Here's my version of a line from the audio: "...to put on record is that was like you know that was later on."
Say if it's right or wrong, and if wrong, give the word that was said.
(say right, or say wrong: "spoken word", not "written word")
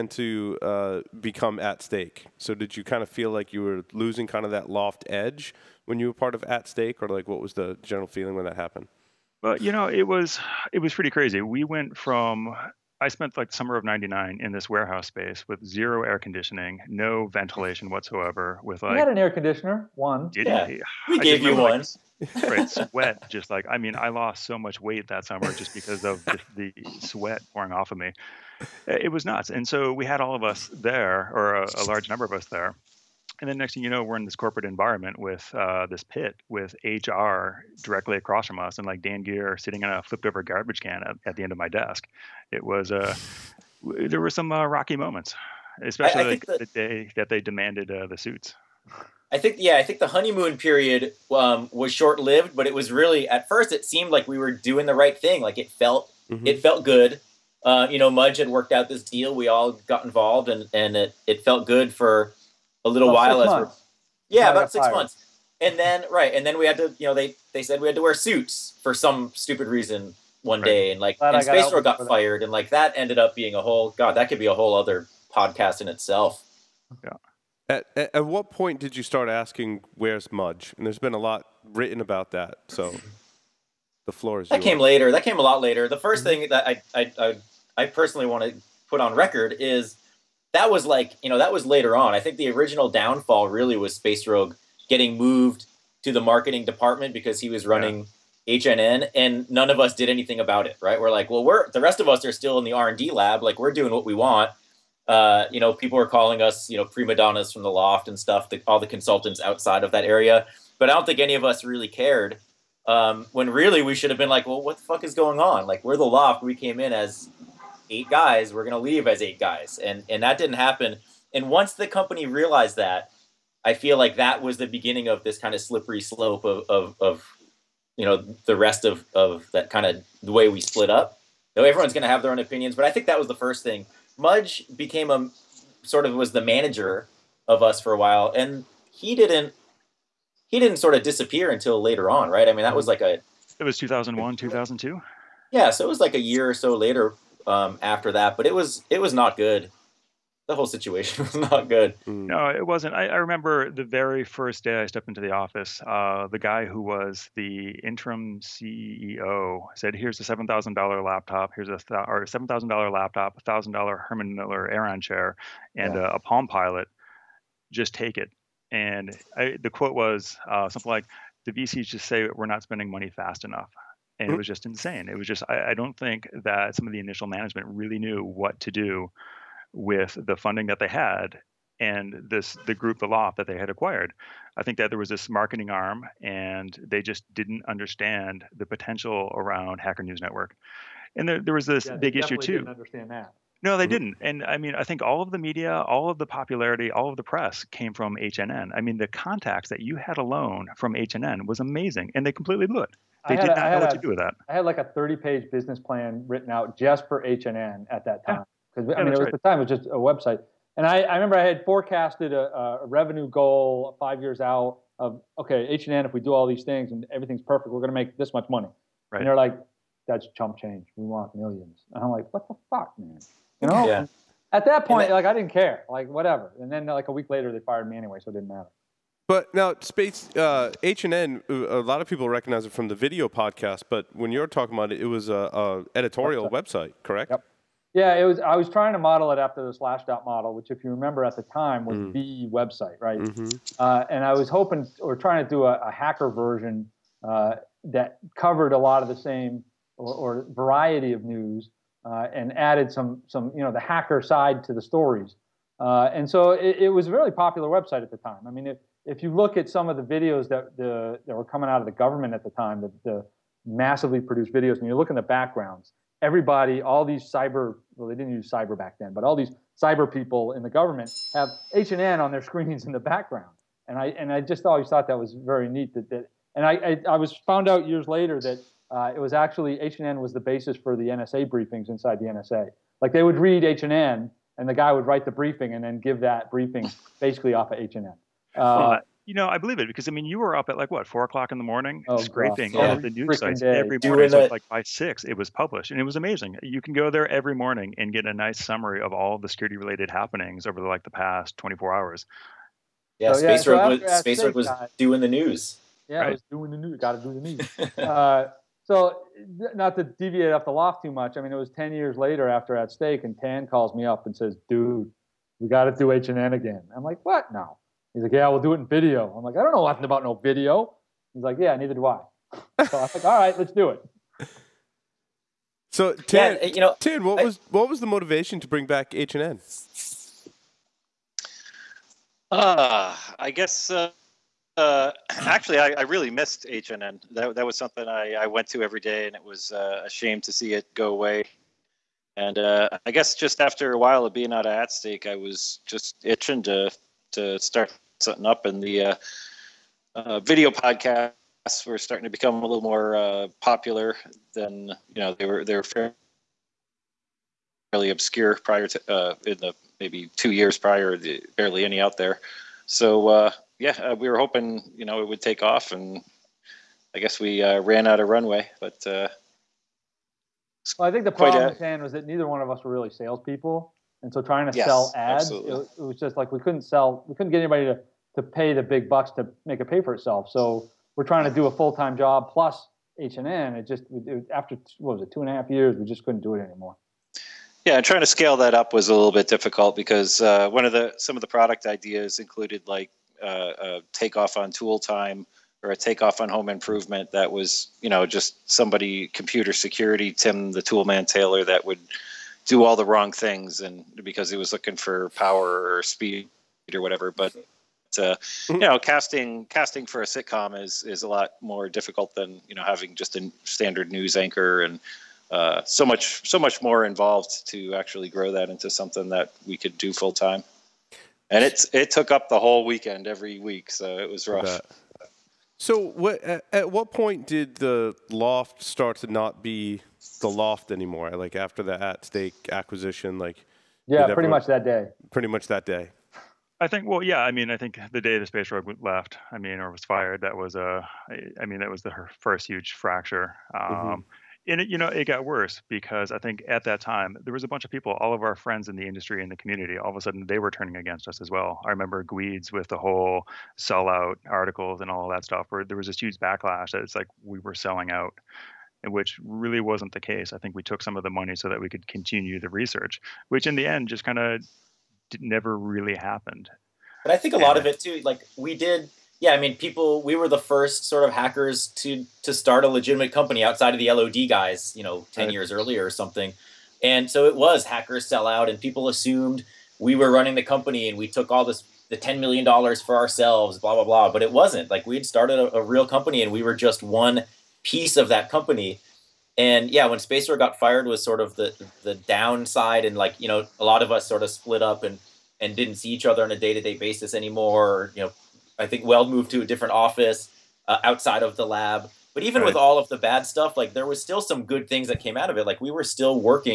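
right.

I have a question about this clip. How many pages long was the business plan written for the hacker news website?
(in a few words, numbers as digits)
30.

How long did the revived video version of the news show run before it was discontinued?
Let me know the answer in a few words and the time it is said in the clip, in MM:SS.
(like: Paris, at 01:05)
2.5 years, at 06:25.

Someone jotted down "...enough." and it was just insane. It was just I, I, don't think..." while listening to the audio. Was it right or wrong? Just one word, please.
right.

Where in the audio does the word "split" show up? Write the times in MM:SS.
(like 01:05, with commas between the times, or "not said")
02:10, 08:14.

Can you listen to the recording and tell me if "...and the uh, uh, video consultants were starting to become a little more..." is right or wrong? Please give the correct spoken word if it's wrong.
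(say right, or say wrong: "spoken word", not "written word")
wrong: "podcasts", not "consultants".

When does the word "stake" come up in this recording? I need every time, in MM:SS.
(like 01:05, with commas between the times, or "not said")
00:01, 00:06, 05:12, 05:44, 07:12.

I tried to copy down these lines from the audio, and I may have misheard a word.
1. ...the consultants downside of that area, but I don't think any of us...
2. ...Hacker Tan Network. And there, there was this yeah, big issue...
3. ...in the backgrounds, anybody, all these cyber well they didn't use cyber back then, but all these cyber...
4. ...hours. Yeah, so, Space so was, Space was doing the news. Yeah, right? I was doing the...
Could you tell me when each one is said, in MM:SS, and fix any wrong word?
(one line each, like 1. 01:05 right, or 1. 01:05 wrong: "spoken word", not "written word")
1. 01:48 wrong: "outside", not "downside"
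2. 03:09 wrong: "News", not "Tan"
3. 04:25 wrong: "everybody", not "anybody"
4. 05:01 right.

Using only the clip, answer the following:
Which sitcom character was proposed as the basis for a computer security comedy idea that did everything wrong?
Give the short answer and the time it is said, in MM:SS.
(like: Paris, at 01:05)
Tim the Toolman Taylor, at 06:40.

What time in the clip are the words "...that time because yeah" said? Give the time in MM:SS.
03:28.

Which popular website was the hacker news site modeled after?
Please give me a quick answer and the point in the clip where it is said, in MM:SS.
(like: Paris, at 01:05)
Slashdot, at 03:59.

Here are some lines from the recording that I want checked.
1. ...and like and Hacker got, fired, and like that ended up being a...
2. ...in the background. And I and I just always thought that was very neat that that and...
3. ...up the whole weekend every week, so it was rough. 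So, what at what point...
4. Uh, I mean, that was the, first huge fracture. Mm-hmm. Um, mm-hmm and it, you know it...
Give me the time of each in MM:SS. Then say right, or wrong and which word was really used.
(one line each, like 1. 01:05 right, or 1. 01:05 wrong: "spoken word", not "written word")
1. 01:10 wrong: "Space", not "Hacker"
2. 04:32 right
3. 07:02 right
4. 07:21 right.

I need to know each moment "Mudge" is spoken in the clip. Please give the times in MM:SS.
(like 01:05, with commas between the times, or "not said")
00:58, 01:20, 02:14.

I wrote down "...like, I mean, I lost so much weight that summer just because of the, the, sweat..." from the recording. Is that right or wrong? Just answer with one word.
right.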